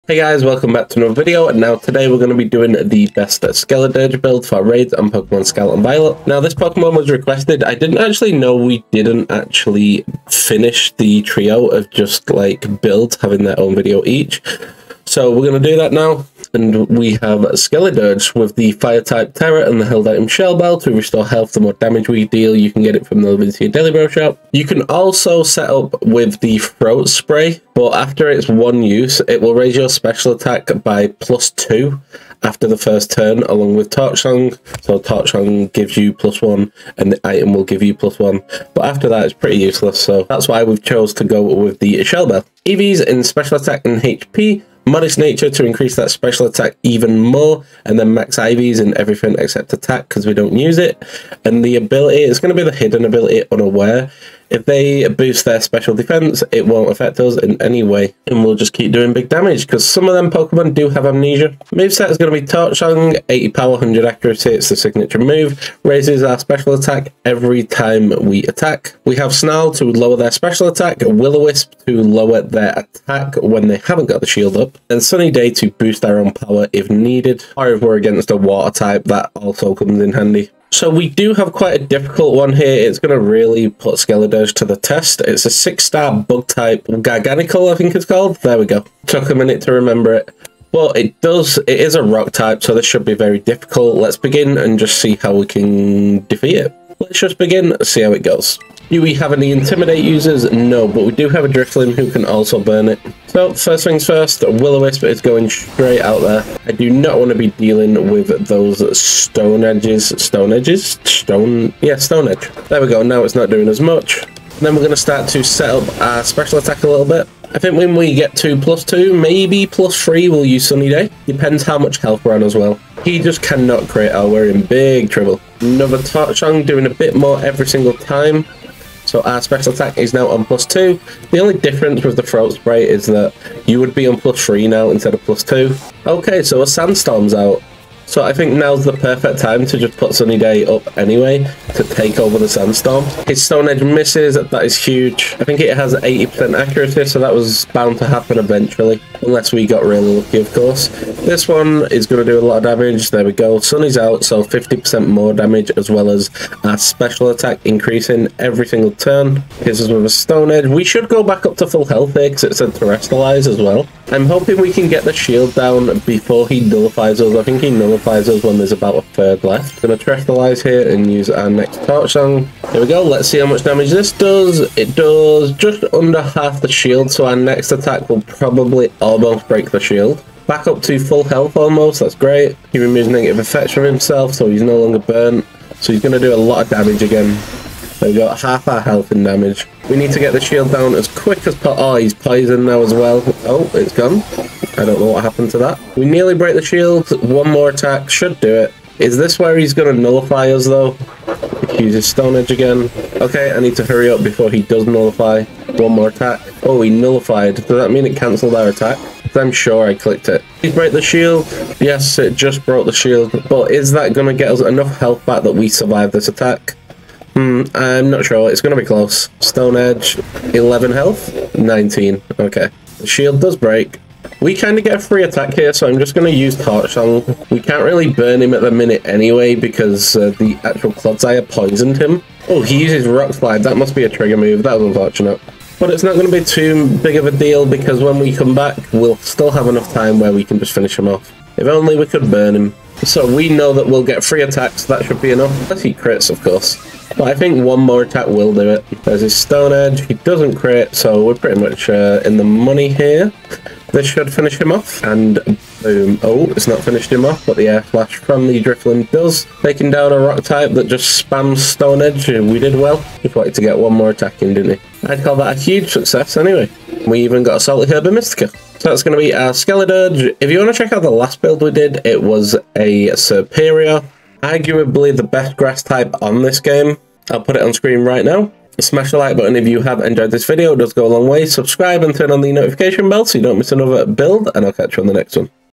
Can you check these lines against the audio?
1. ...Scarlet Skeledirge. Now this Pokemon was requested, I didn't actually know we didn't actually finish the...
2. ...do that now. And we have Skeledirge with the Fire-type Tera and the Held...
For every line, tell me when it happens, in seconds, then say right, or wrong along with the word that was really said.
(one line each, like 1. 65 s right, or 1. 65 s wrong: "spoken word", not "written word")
1. 5 s wrong: "Violet", not "Skeledirge"
2. 15 s right.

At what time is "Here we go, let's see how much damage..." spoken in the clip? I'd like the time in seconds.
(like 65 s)
172 s.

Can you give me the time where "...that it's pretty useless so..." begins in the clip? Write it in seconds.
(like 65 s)
39 s.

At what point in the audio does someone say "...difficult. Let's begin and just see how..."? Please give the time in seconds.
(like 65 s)
93 s.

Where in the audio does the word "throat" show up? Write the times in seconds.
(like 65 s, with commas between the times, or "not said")
26 s, 132 s.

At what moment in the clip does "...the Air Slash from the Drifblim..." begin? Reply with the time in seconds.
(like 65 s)
257 s.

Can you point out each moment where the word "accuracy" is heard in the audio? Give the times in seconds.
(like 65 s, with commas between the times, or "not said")
64 s, 146 s.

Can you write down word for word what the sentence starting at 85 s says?
It's a six-star bug type, Garganacl, I think it's called.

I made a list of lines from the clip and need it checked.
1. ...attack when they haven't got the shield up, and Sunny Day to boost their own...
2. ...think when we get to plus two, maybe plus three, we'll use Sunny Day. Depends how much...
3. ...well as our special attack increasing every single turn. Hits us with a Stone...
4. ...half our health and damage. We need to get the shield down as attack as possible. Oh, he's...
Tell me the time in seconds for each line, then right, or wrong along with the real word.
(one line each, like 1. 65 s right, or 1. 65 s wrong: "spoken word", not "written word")
1. 72 s right
2. 117 s right
3. 155 s right
4. 188 s wrong: "quick", not "attack".